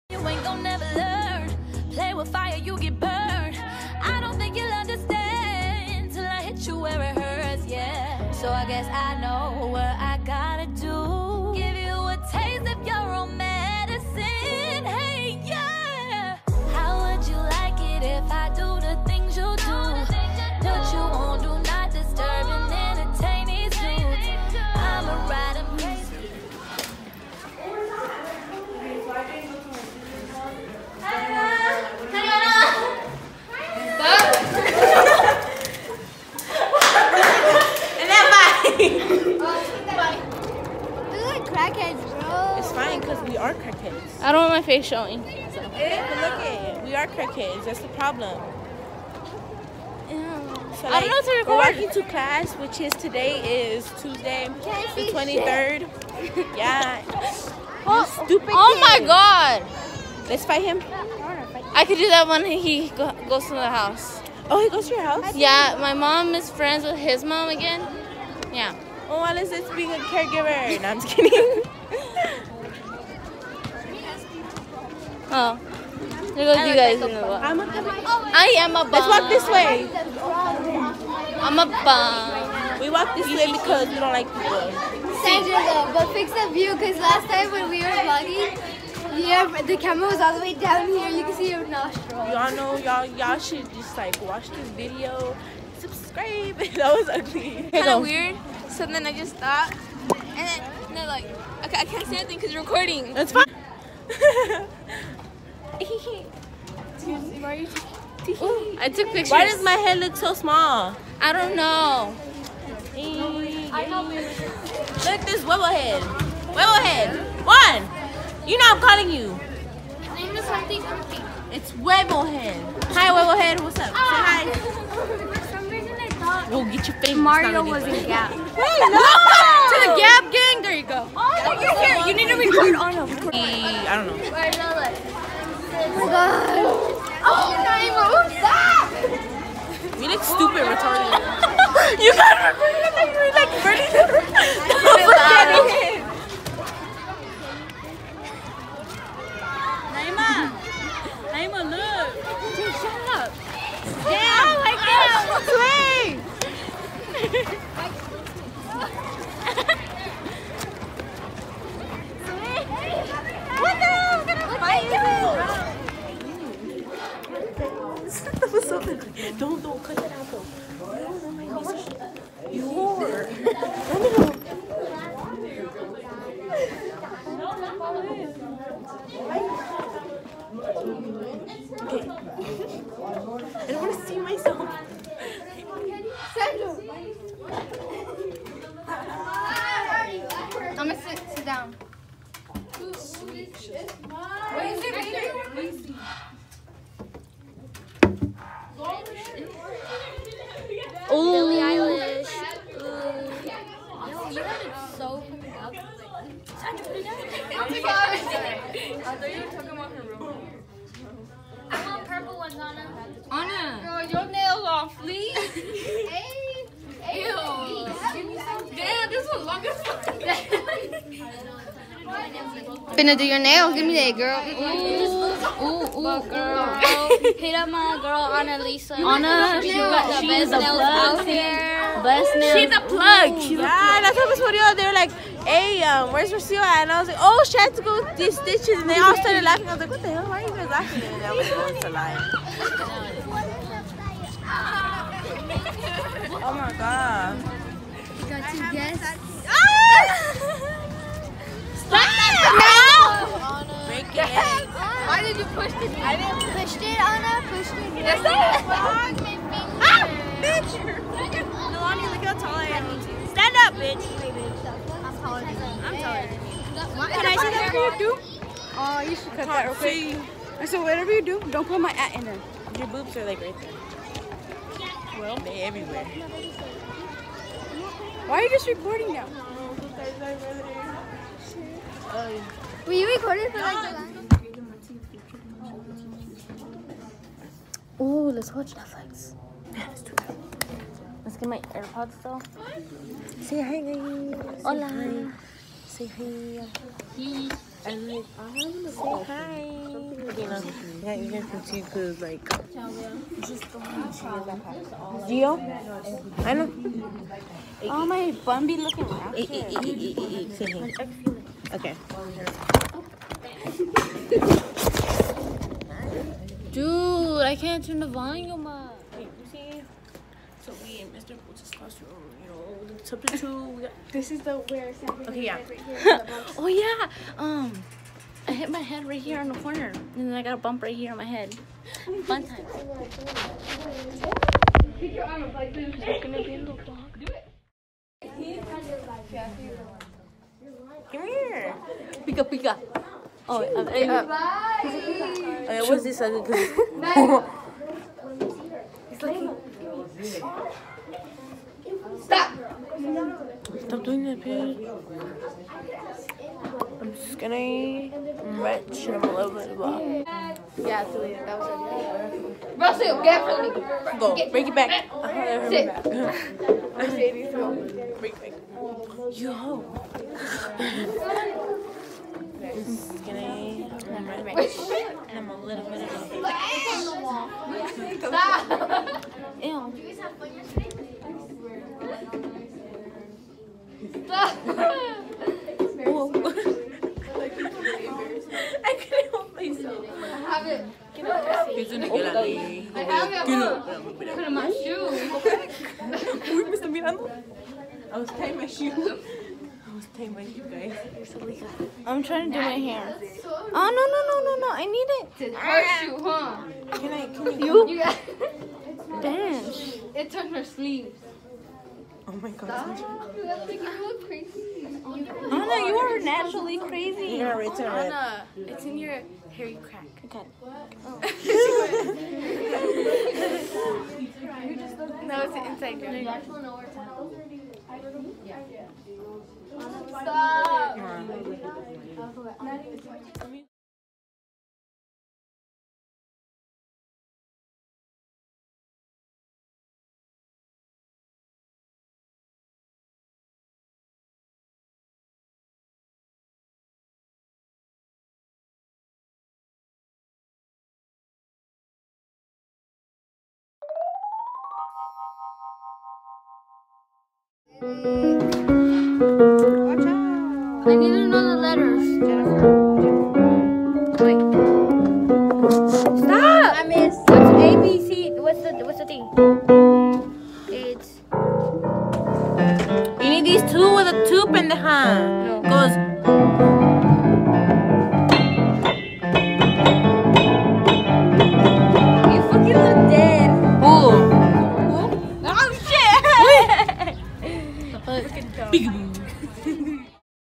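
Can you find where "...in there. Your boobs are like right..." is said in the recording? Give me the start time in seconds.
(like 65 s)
272 s.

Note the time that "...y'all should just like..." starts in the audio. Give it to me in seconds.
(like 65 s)
93 s.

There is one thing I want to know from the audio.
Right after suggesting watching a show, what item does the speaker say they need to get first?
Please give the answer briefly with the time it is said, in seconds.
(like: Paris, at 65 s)
AirPods, at 291 s.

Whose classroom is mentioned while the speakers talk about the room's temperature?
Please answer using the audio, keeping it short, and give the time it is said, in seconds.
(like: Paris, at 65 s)
Mr. Bolt's, at 321 s.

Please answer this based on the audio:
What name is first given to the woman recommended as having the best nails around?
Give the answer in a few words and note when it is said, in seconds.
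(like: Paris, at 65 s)
Annalisa, at 228 s.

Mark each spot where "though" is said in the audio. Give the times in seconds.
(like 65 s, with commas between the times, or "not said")
85 s, 170 s, 292 s.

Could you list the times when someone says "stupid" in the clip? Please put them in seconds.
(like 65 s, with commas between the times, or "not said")
58 s, 140 s.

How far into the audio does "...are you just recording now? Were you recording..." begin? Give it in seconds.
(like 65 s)
278 s.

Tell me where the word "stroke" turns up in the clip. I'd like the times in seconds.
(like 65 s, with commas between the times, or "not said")
not said.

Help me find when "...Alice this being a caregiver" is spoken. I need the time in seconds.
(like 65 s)
69 s.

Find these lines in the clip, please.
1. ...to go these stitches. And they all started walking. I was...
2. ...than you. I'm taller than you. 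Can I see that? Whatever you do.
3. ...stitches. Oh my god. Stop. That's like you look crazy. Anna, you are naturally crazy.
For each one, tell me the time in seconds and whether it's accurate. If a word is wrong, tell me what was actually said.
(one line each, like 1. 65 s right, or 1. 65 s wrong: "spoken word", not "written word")
1. 237 s wrong: "laughing", not "walking"
2. 265 s right
3. 410 s wrong: "sleeves", not "stitches".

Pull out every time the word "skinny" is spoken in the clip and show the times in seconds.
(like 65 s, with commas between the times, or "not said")
357 s, 372 s.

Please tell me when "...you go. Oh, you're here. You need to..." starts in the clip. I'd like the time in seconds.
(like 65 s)
130 s.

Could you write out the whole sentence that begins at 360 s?
Yeah, Julia, that was our Russell, get from me.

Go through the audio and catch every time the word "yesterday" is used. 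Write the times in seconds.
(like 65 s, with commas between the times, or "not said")
380 s.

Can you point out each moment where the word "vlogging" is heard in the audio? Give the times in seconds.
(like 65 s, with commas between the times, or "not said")
88 s.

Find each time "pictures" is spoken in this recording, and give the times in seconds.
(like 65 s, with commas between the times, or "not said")
109 s.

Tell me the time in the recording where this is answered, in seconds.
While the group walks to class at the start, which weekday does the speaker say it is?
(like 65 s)
54 s.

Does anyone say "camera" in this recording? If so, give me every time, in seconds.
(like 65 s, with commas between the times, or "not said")
89 s.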